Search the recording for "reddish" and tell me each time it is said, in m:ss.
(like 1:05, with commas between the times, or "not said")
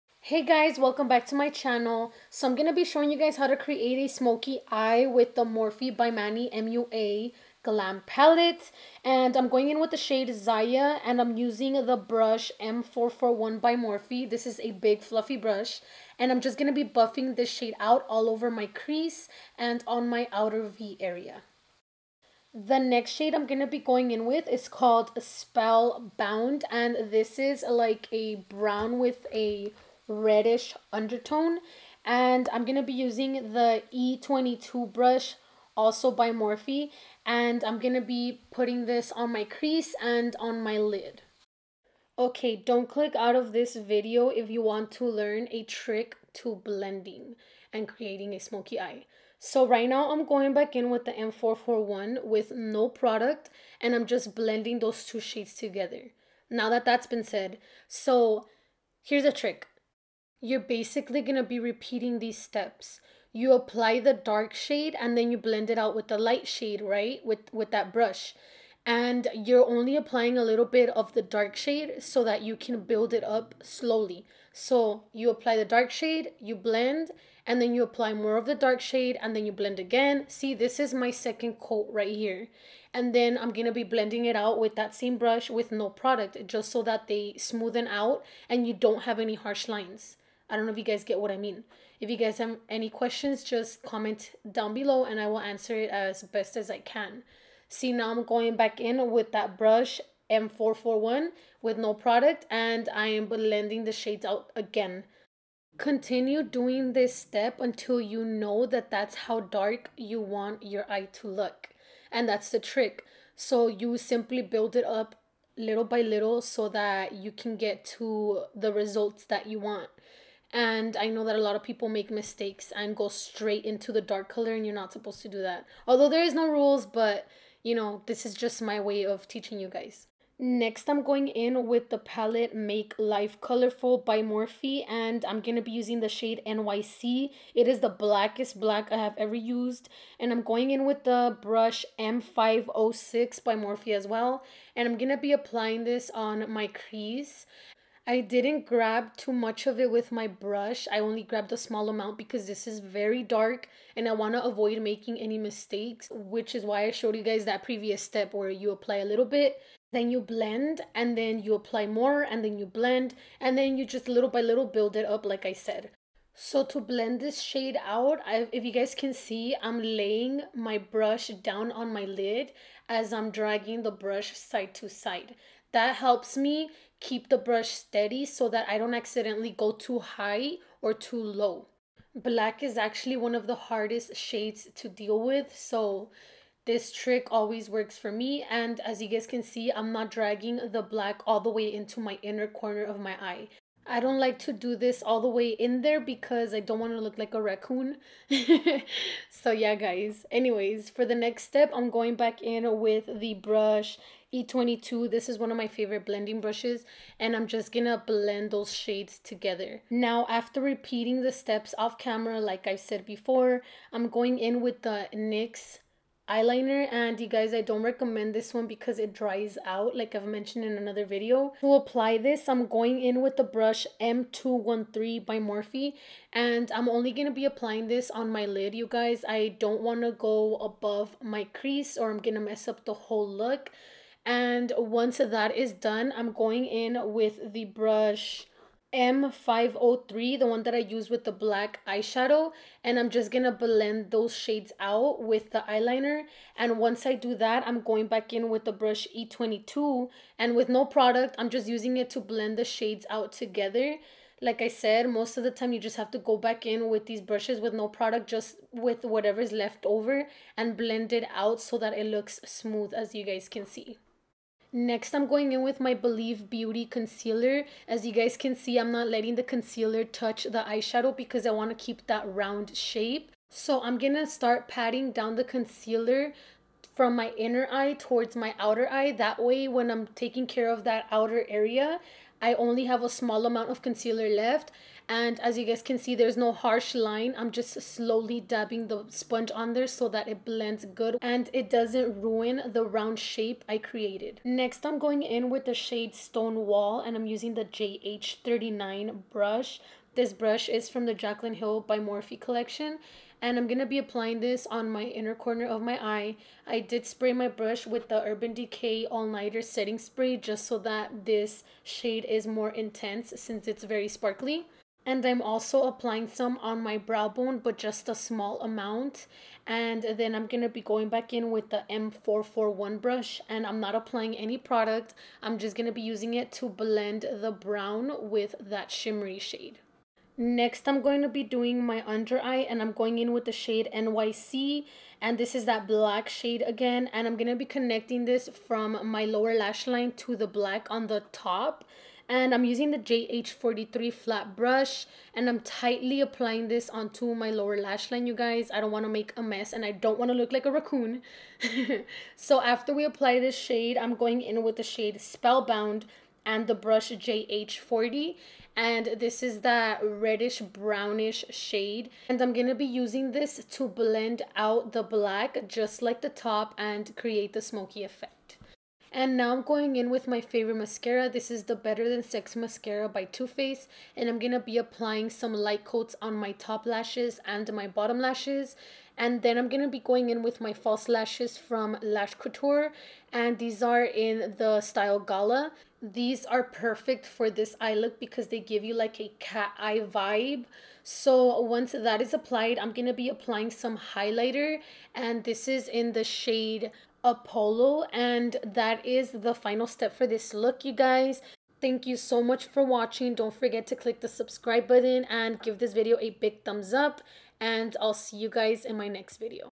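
0:30, 6:00.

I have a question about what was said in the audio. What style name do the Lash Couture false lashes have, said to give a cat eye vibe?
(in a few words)
Gala.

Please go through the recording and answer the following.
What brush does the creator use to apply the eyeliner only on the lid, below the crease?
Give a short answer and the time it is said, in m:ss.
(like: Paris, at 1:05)
M213, at 3:43.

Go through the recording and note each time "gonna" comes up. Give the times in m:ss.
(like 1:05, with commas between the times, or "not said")
3:27, 6:02.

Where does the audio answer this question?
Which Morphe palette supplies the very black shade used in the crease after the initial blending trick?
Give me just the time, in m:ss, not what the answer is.
2:12.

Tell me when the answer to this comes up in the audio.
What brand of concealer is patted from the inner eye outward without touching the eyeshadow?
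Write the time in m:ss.
4:25.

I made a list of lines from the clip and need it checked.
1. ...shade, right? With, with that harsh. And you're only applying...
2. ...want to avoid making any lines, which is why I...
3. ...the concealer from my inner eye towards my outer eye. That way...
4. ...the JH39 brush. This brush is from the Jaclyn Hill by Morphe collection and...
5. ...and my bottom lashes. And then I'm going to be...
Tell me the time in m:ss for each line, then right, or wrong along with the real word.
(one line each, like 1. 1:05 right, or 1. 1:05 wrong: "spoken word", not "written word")
1. 1:06 wrong: "brush", not "harsh"
2. 2:34 wrong: "mistakes", not "lines"
3. 4:35 right
4. 4:57 right
5. 6:17 right.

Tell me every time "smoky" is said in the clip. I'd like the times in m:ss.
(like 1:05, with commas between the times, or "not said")
0:04, 0:48, 6:07.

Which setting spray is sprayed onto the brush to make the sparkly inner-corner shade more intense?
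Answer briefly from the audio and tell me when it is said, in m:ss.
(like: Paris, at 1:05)
Urban Decay All Nighter, at 5:08.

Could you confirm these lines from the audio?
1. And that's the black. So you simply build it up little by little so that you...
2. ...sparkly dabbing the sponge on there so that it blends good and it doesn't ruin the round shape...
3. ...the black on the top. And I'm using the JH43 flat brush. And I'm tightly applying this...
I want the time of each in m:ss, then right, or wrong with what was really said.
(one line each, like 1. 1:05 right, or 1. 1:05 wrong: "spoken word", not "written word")
1. 1:52 wrong: "trick", not "black"
2. 4:47 wrong: "slowly", not "sparkly"
3. 5:40 right.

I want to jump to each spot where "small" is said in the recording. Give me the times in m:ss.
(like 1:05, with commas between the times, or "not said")
2:31, 4:43, 5:18.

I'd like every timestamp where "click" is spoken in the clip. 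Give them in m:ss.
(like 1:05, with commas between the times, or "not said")
0:42, 6:43.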